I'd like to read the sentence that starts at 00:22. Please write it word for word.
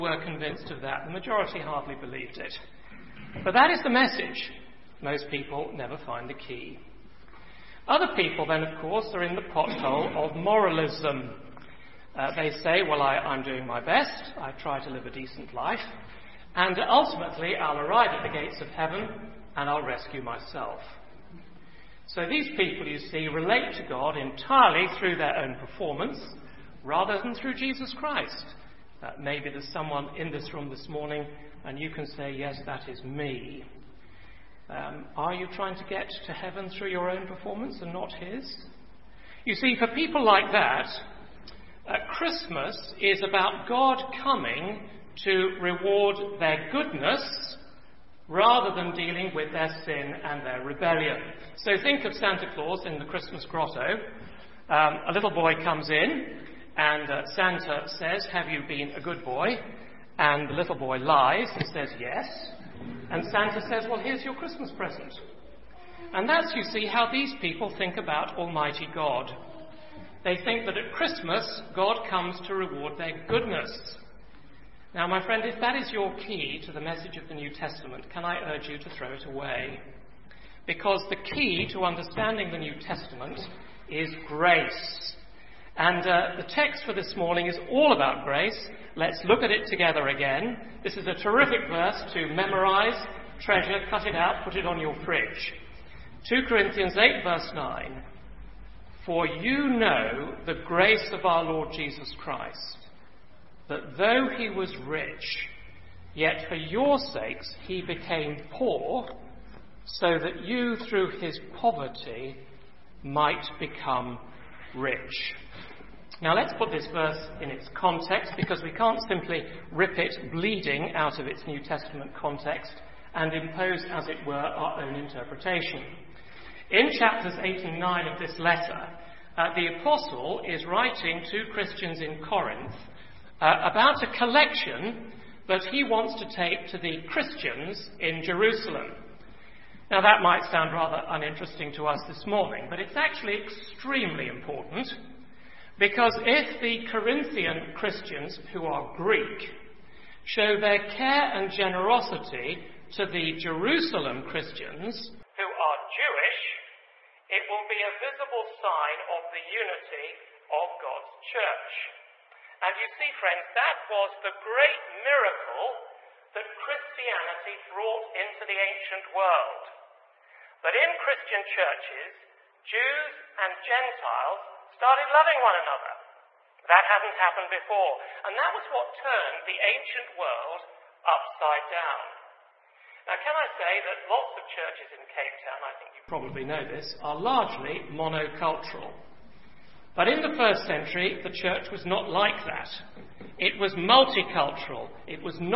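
So these people, you see, relate to God entirely through their own performance rather than through Jesus Christ.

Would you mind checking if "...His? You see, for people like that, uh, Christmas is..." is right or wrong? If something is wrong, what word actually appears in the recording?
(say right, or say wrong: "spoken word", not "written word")
right.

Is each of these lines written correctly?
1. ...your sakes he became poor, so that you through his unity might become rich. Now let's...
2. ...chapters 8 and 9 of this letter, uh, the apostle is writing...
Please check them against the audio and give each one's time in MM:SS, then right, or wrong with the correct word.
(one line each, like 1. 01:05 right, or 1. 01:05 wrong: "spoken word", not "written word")
1. 01:46 wrong: "poverty", not "unity"
2. 02:06 right.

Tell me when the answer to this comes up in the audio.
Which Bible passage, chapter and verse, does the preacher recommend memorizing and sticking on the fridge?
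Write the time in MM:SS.
01:36.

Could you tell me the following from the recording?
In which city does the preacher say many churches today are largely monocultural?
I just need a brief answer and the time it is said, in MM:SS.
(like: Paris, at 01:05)
Cape Town, at 03:05.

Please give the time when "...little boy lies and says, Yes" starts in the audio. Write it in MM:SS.
01:00.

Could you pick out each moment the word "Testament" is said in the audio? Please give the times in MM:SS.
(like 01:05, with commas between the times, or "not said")
01:17, 01:22, 02:01.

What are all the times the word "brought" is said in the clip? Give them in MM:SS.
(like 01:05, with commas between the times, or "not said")
02:47.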